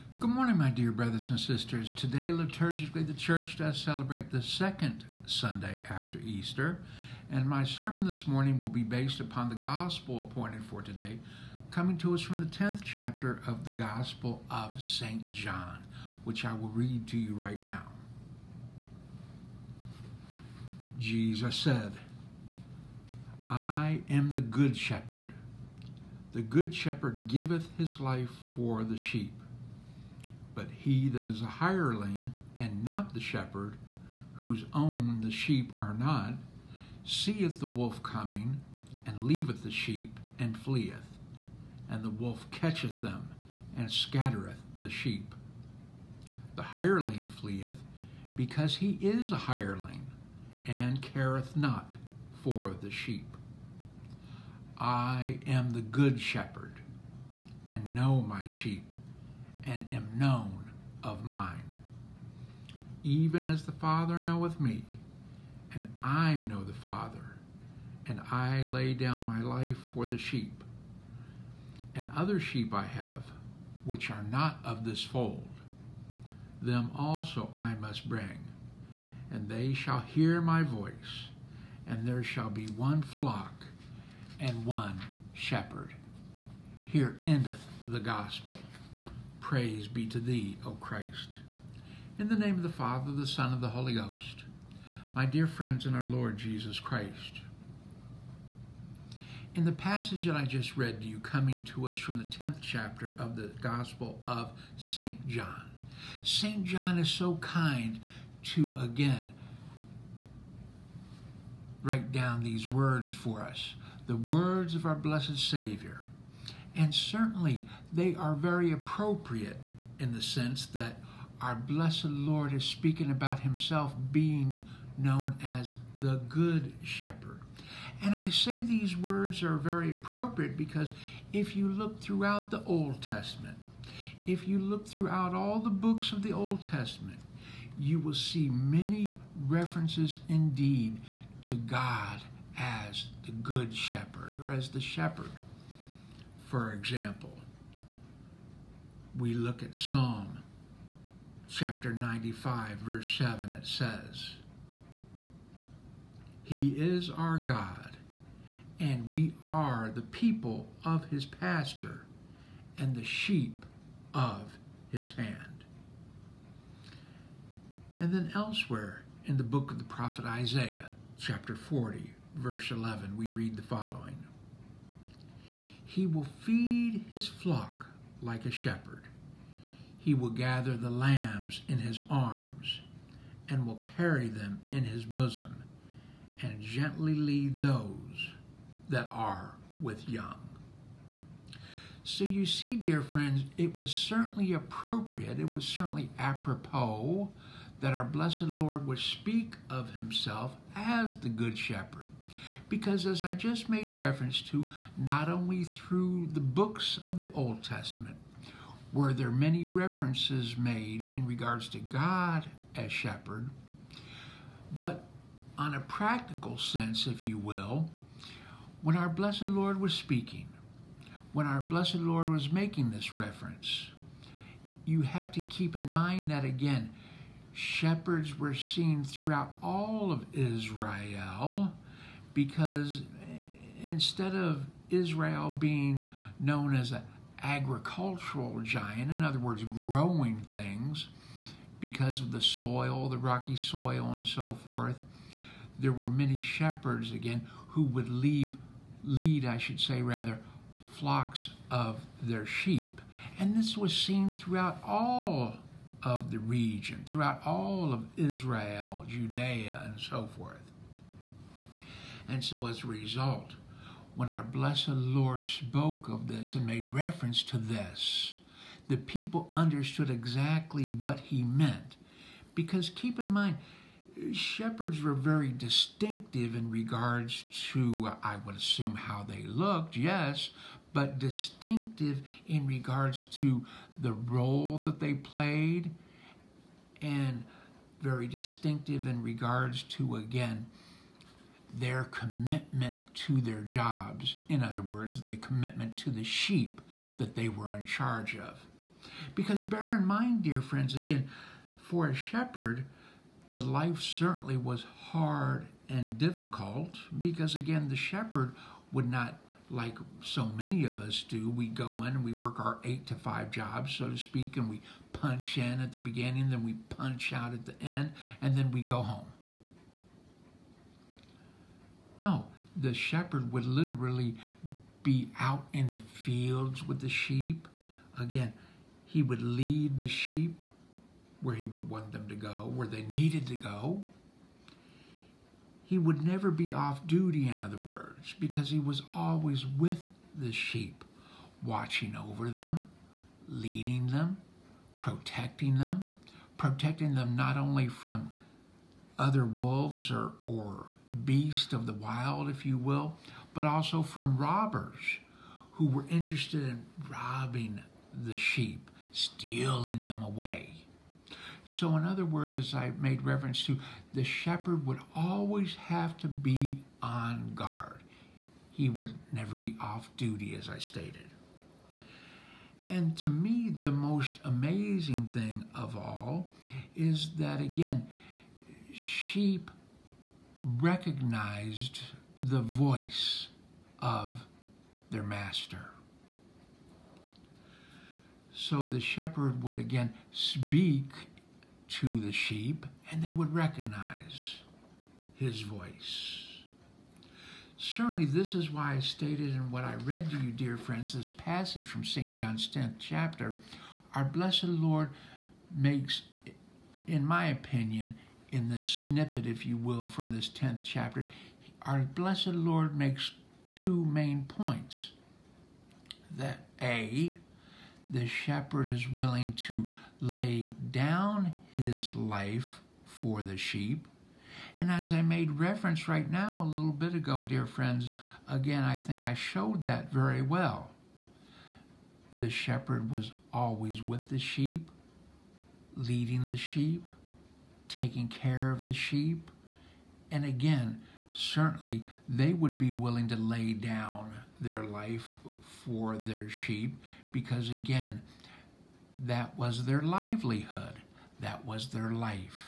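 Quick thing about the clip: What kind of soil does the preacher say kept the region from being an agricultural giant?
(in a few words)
Rocky soil.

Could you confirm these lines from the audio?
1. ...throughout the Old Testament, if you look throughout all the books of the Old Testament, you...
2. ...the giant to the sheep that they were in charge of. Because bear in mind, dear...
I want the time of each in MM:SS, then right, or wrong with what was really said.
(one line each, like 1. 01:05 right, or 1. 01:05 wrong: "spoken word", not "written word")
1. 02:11 right
2. 04:55 wrong: "commitment", not "giant".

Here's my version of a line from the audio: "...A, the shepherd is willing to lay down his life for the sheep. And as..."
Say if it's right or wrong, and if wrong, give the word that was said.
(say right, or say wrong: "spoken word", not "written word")
right.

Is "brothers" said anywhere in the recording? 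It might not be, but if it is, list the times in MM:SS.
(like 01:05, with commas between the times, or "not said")
00:00.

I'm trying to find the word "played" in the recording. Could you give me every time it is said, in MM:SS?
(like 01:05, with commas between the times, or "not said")
04:45.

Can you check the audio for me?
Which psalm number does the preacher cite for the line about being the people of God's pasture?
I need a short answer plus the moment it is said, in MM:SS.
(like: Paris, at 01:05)
95, at 02:29.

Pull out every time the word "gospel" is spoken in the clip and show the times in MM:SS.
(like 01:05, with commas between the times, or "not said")
00:09, 00:13, 01:27, 01:43.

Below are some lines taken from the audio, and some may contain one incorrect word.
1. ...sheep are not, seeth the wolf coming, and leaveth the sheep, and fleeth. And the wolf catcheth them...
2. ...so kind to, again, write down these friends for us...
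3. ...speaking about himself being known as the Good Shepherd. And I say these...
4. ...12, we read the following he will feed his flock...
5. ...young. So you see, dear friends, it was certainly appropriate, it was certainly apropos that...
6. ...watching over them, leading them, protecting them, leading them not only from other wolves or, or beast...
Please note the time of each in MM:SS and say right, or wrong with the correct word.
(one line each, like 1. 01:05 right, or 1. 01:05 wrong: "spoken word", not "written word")
1. 00:35 right
2. 01:47 wrong: "words", not "friends"
3. 02:02 right
4. 02:52 wrong: "11", not "12"
5. 03:10 right
6. 05:41 wrong: "protecting", not "leading".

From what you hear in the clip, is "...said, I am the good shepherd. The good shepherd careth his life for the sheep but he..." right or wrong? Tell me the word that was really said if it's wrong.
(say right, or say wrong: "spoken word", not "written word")
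wrong: "giveth", not "careth".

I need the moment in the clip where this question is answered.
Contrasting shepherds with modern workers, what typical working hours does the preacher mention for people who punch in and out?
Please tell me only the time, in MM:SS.
05:12.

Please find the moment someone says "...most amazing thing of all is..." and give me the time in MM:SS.
06:13.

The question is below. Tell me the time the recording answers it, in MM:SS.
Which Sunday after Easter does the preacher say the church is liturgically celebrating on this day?
00:04.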